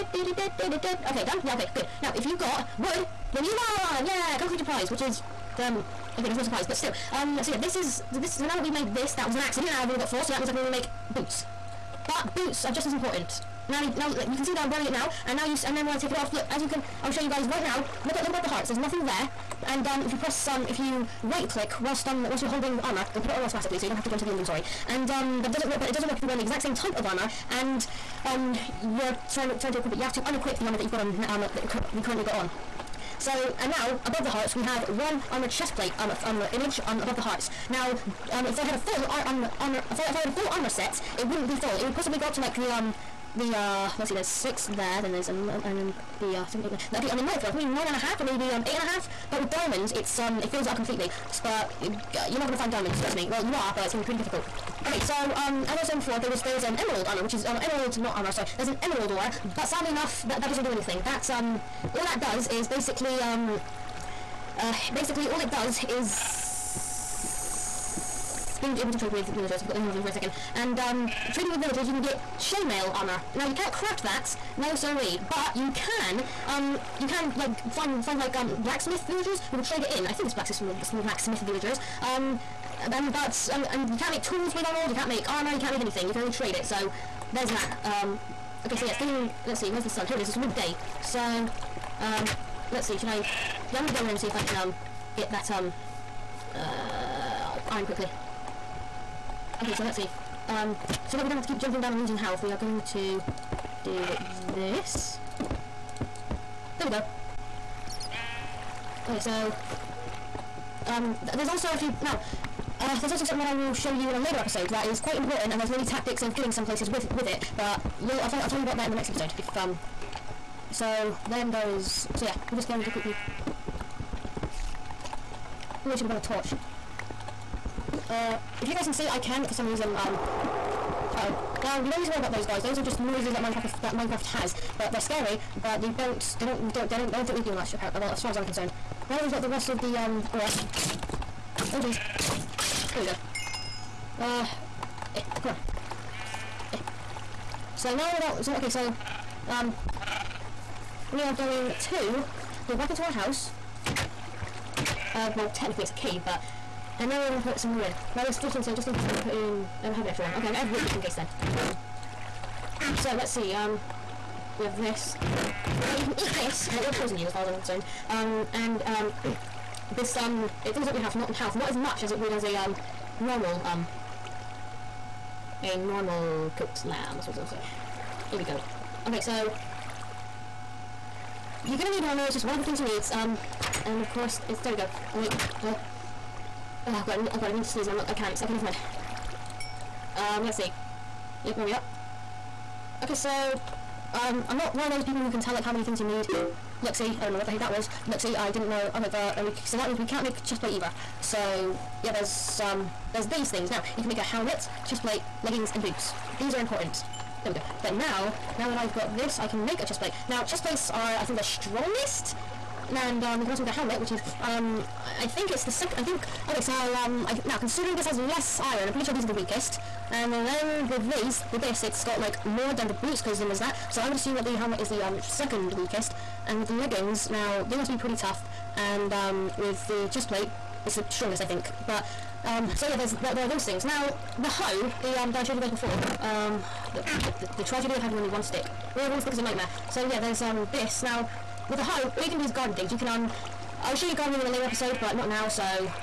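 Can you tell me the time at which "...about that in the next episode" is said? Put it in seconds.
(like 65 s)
118 s.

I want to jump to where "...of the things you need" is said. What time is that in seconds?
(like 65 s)
182 s.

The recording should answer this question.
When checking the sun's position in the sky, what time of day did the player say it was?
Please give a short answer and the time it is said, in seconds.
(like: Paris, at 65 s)
Midday, at 90 s.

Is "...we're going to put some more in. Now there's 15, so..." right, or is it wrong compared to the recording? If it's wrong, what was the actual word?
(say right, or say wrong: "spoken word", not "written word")
right.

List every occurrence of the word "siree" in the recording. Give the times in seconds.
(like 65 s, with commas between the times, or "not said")
74 s.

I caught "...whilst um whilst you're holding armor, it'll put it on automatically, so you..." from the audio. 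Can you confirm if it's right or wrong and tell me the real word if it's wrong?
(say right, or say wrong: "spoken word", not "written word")
right.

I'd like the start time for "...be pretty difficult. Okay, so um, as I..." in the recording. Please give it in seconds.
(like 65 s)
54 s.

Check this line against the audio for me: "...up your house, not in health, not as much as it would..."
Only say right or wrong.
right.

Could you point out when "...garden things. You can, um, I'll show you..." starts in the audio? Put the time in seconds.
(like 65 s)
242 s.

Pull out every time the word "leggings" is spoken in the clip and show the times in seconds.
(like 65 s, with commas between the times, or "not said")
205 s, 226 s.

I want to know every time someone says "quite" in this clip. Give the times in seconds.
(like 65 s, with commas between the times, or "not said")
114 s.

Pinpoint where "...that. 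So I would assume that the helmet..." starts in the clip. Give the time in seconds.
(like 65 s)
223 s.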